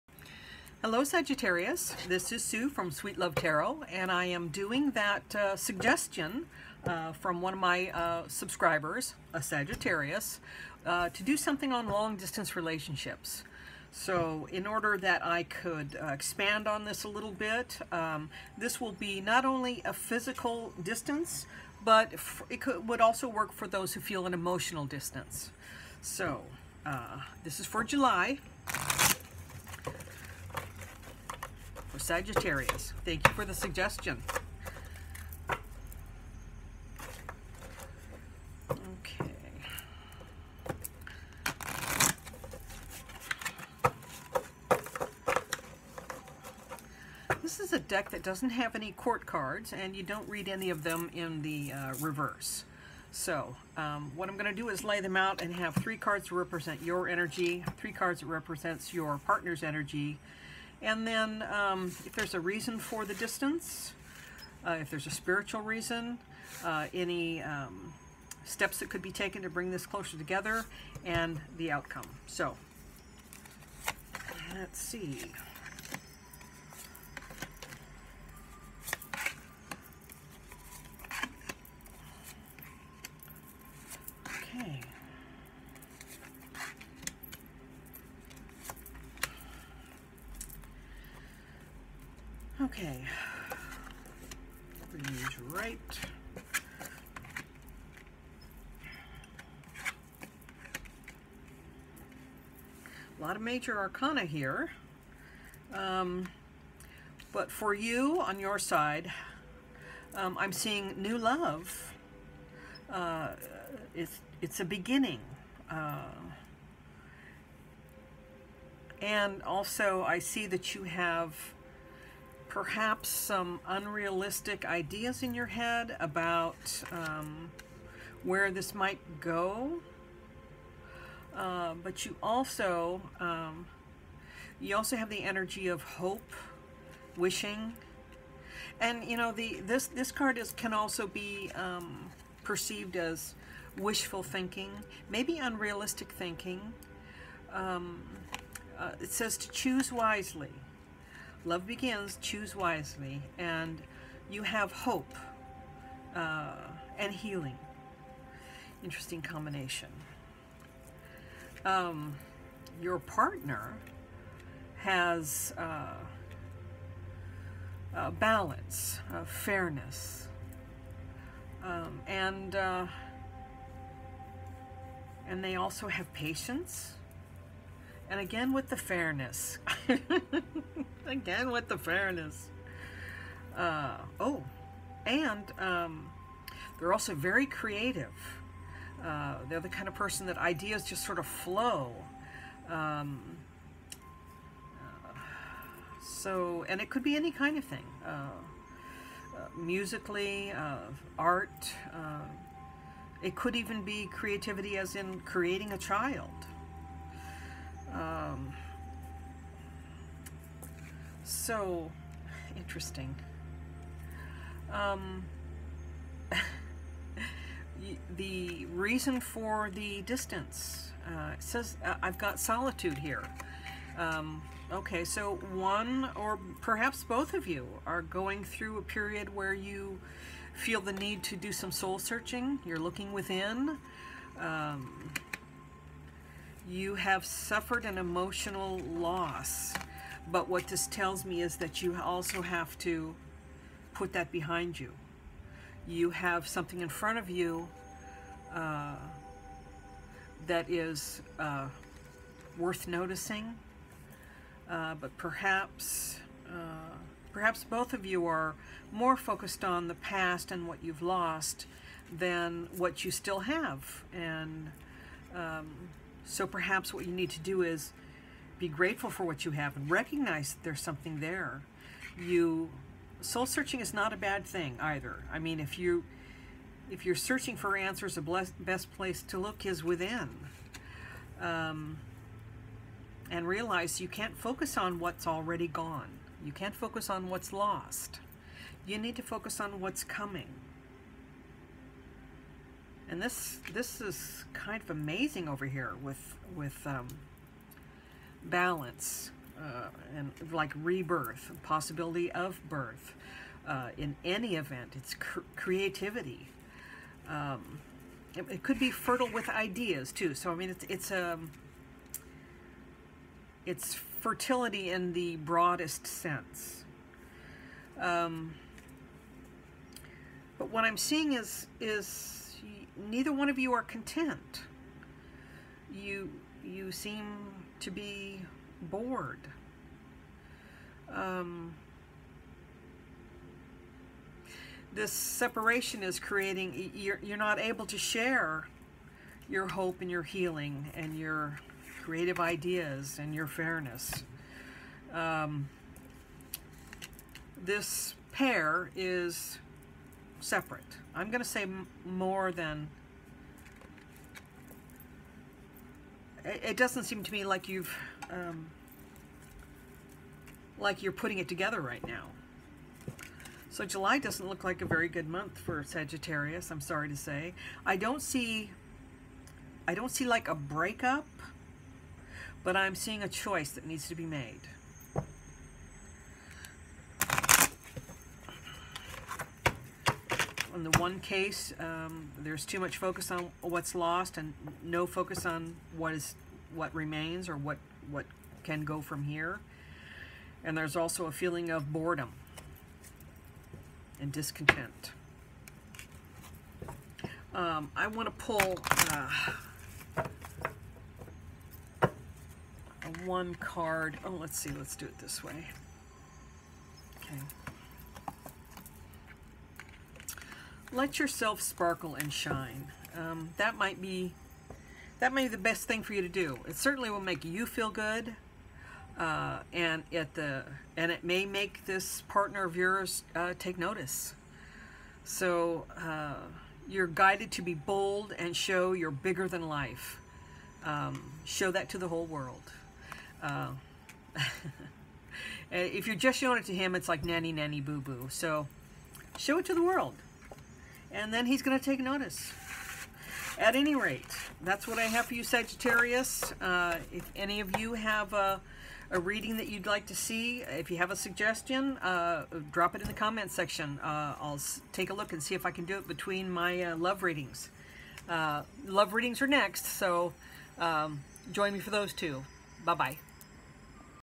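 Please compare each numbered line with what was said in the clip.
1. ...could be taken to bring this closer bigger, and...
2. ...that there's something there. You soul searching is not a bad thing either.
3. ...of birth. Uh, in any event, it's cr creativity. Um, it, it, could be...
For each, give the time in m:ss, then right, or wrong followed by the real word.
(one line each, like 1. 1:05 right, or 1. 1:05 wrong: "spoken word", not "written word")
1. 1:08 wrong: "together", not "bigger"
2. 4:30 right
3. 5:02 right.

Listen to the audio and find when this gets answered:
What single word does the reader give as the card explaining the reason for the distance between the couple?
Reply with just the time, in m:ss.
3:42.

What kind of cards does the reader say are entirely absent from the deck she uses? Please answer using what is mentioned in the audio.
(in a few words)
Court cards.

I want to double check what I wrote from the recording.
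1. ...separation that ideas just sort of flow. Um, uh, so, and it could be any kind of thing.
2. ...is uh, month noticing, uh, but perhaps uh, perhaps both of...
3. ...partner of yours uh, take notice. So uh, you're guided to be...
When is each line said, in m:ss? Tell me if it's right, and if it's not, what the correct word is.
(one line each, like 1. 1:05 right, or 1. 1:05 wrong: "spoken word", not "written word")
1. 3:09 wrong: "person", not "separation"
2. 4:10 wrong: "worth", not "month"
3. 7:02 right.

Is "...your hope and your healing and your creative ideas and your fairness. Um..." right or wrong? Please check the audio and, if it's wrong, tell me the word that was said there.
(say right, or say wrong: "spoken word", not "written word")
right.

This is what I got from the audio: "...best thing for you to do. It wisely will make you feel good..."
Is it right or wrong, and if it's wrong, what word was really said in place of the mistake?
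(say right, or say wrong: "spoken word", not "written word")
wrong: "certainly", not "wisely".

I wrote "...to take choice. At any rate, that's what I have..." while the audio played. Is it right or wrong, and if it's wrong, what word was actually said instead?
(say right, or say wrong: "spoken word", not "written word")
wrong: "notice", not "choice".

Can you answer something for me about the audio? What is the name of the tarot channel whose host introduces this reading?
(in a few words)
Sweet Love Tarot.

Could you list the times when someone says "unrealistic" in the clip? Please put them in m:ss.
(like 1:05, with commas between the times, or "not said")
2:03, 2:25.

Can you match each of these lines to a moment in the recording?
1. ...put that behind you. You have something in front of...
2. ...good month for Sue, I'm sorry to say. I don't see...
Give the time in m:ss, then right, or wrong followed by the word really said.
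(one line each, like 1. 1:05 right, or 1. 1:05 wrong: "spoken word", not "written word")
1. 4:03 right
2. 6:05 wrong: "Sagittarius", not "Sue".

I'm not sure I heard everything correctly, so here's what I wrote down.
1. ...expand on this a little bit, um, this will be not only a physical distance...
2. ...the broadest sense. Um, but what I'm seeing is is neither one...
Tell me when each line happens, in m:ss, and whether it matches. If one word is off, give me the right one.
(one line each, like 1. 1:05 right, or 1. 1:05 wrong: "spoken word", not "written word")
1. 0:16 right
2. 5:15 right.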